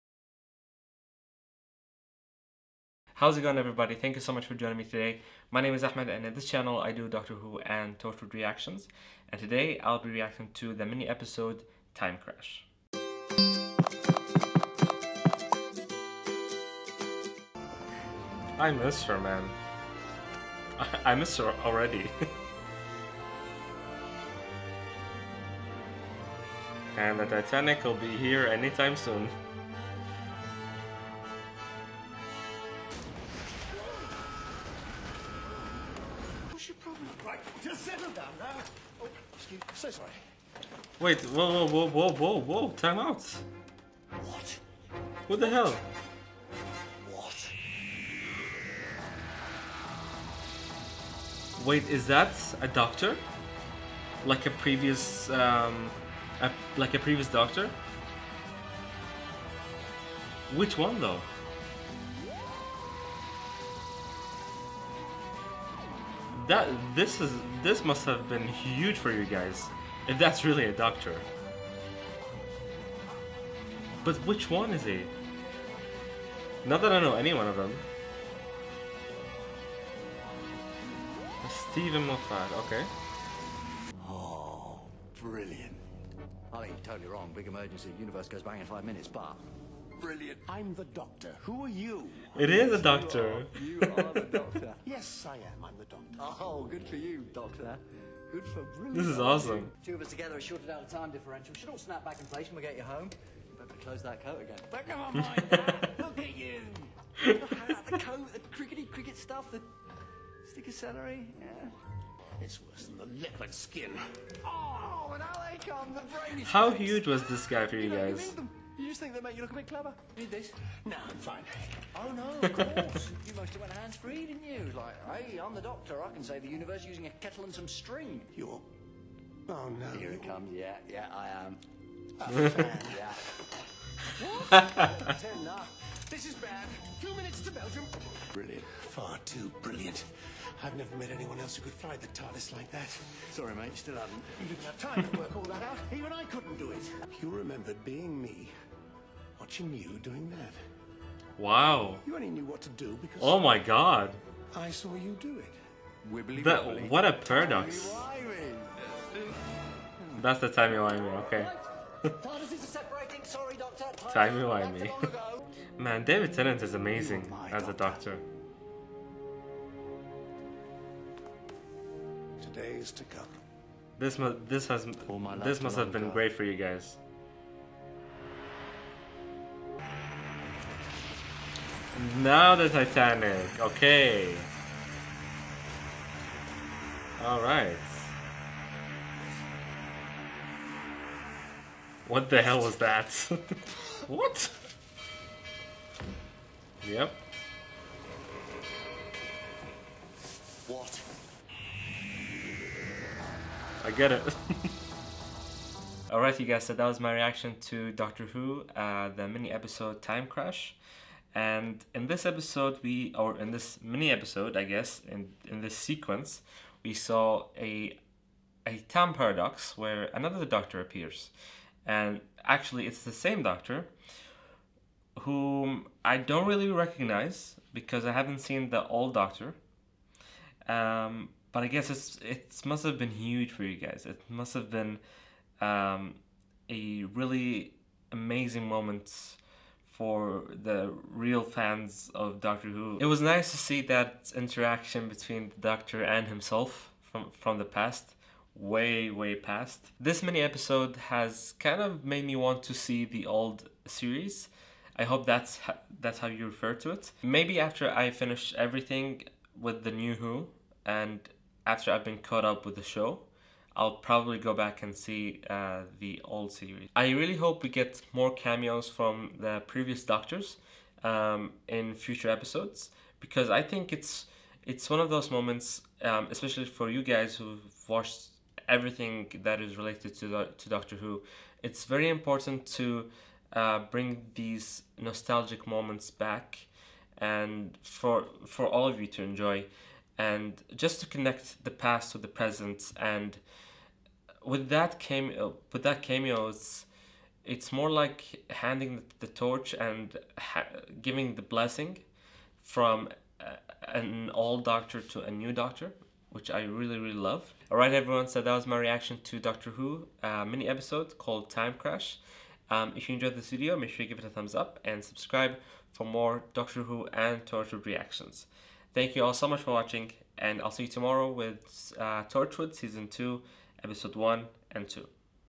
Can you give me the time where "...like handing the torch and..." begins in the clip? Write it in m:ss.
4:57.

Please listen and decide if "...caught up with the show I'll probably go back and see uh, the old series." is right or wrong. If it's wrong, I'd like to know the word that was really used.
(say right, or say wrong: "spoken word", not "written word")
right.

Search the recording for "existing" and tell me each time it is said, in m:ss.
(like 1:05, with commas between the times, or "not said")
not said.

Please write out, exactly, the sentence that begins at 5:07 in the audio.
All right, everyone, so that was my reaction to Doctor Who uh, mini episode called Time Crash.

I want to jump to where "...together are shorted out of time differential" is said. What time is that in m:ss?
1:40.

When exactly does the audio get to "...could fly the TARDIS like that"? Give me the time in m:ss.
2:21.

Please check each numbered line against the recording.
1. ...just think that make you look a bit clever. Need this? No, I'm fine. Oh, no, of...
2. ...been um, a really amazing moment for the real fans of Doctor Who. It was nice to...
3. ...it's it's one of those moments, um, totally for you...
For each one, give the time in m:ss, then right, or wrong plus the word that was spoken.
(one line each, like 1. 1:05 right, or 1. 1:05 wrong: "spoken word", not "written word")
1. 1:58 right
2. 3:54 right
3. 4:33 wrong: "especially", not "totally".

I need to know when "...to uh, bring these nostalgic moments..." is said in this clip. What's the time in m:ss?
4:42.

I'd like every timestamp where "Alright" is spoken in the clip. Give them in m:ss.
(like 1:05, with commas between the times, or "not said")
3:07, 3:26.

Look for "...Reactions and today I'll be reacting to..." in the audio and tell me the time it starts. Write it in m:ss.
0:08.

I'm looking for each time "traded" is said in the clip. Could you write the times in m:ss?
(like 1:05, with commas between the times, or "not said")
not said.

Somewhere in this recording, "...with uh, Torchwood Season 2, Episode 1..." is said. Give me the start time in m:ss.
5:21.